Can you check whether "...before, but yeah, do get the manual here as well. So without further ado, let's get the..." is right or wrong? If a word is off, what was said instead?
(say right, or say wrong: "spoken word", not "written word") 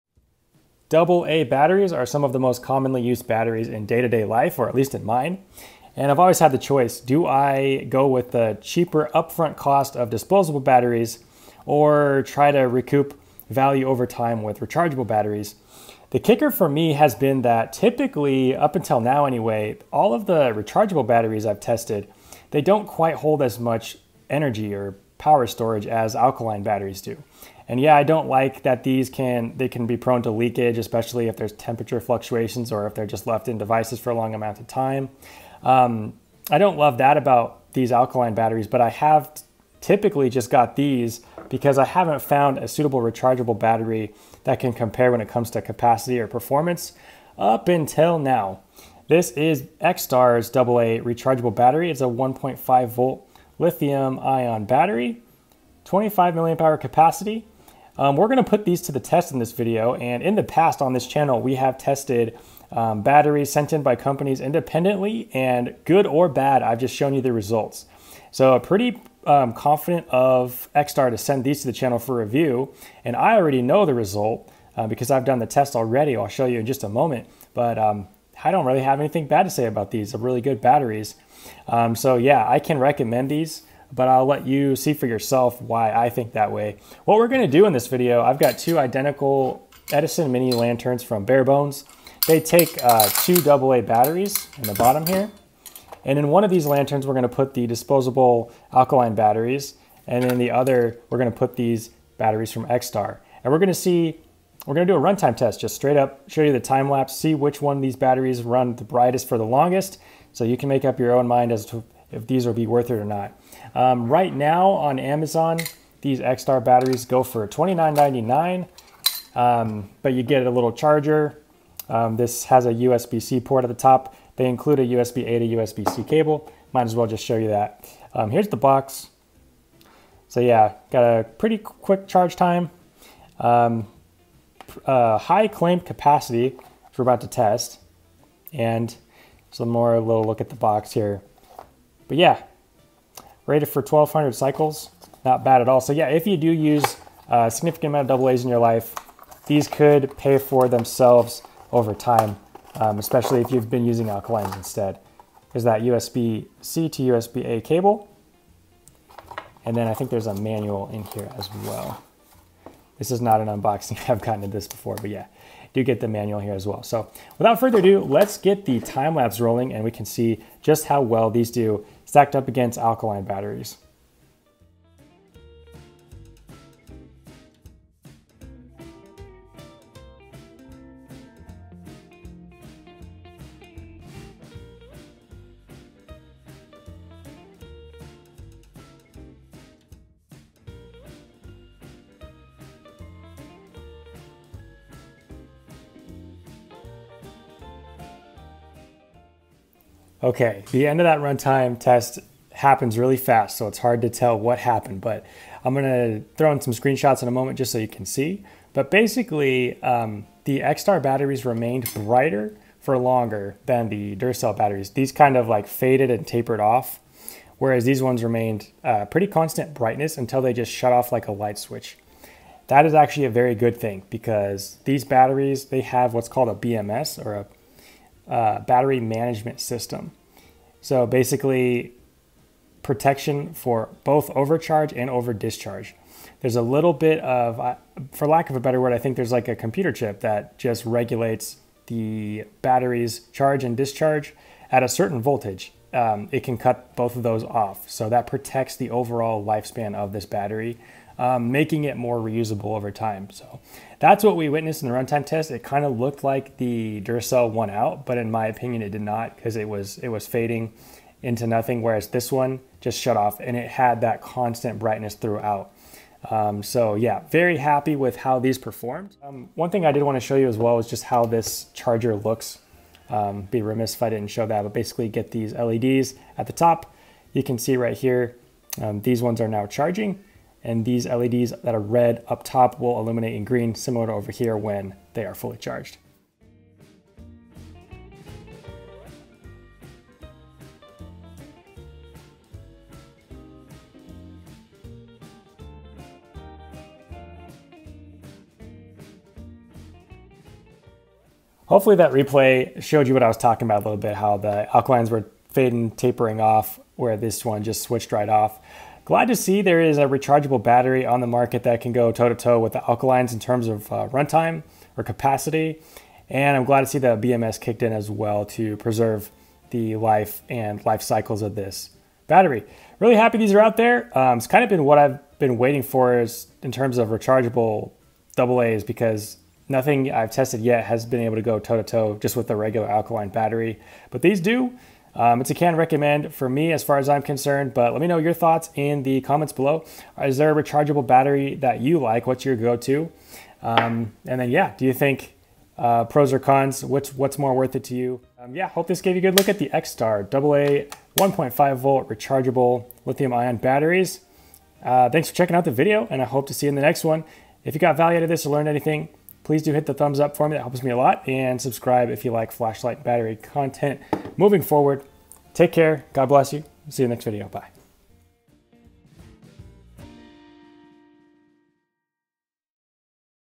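right.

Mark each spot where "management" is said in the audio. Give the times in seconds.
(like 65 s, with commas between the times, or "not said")
229 s.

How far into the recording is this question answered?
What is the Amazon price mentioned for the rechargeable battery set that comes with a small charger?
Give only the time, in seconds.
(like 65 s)
117 s.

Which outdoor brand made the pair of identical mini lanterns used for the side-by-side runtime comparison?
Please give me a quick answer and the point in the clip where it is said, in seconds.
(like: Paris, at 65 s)
Barebones, at 91 s.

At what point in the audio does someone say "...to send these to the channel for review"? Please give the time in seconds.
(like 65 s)
71 s.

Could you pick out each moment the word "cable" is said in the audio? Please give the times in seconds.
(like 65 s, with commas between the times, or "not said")
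126 s, 157 s.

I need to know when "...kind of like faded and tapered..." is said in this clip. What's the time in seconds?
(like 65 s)
215 s.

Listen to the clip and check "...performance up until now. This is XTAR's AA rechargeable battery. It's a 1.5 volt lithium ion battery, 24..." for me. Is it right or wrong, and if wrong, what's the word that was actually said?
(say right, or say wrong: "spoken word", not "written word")
wrong: "25", not "24".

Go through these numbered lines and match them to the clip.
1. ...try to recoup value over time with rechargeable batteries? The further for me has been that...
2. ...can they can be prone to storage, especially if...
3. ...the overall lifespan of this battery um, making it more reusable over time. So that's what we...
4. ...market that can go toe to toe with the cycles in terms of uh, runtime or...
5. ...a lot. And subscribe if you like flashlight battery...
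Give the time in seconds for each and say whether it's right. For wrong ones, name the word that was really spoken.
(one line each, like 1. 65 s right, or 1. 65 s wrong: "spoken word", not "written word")
1. 12 s wrong: "kicker", not "further"
2. 29 s wrong: "leakage", not "storage"
3. 248 s right
4. 311 s wrong: "alkalines", not "cycles"
5. 360 s right.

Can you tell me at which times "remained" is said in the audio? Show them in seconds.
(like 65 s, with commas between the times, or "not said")
211 s, 218 s.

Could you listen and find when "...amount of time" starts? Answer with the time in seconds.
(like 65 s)
34 s.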